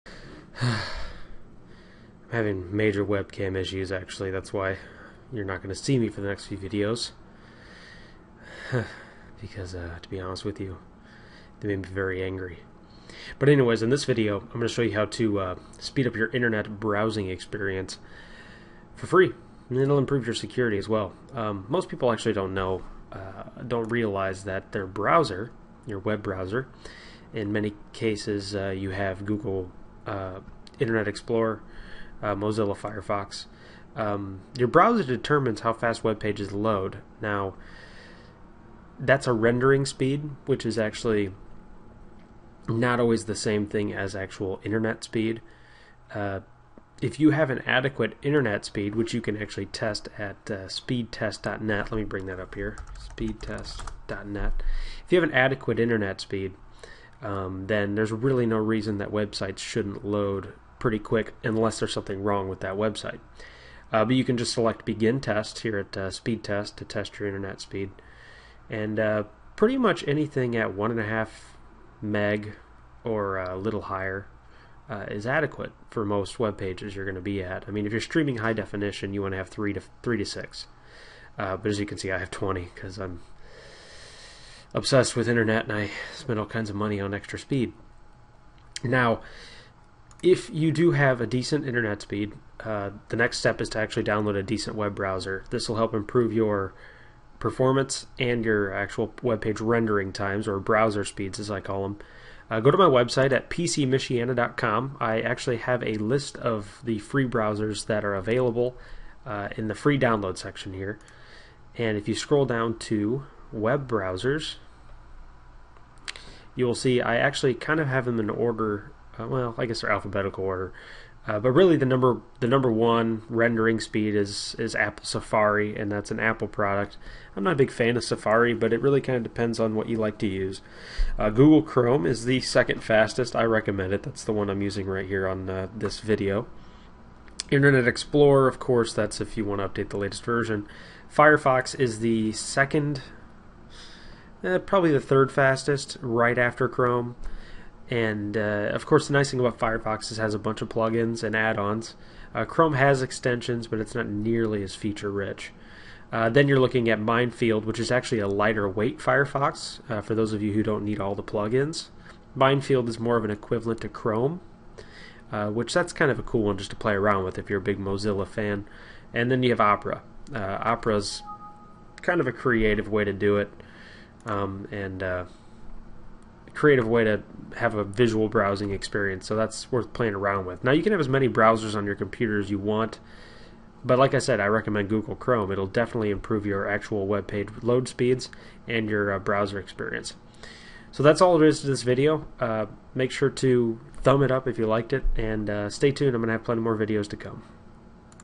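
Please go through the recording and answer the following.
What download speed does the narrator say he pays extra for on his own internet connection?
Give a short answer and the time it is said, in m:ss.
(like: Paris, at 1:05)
20, at 1:22.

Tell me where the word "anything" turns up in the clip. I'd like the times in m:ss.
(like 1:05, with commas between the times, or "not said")
1:10.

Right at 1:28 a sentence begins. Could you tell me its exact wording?
Now, if you do have a decent internet speed, uh, the next step is to actually download a decent web browser.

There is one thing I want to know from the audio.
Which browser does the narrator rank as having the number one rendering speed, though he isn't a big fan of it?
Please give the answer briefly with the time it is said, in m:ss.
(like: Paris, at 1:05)
Apple Safari, at 2:04.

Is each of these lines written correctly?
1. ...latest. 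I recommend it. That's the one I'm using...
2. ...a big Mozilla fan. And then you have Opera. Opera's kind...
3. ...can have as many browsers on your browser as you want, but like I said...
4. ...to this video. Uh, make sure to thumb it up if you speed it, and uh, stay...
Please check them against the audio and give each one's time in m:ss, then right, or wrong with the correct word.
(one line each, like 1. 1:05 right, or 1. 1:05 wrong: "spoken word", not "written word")
1. 2:12 wrong: "fastest", not "latest"
2. 2:47 right
3. 3:00 wrong: "computer", not "browser"
4. 3:11 wrong: "liked", not "speed".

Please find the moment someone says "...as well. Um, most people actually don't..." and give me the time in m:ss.
0:20.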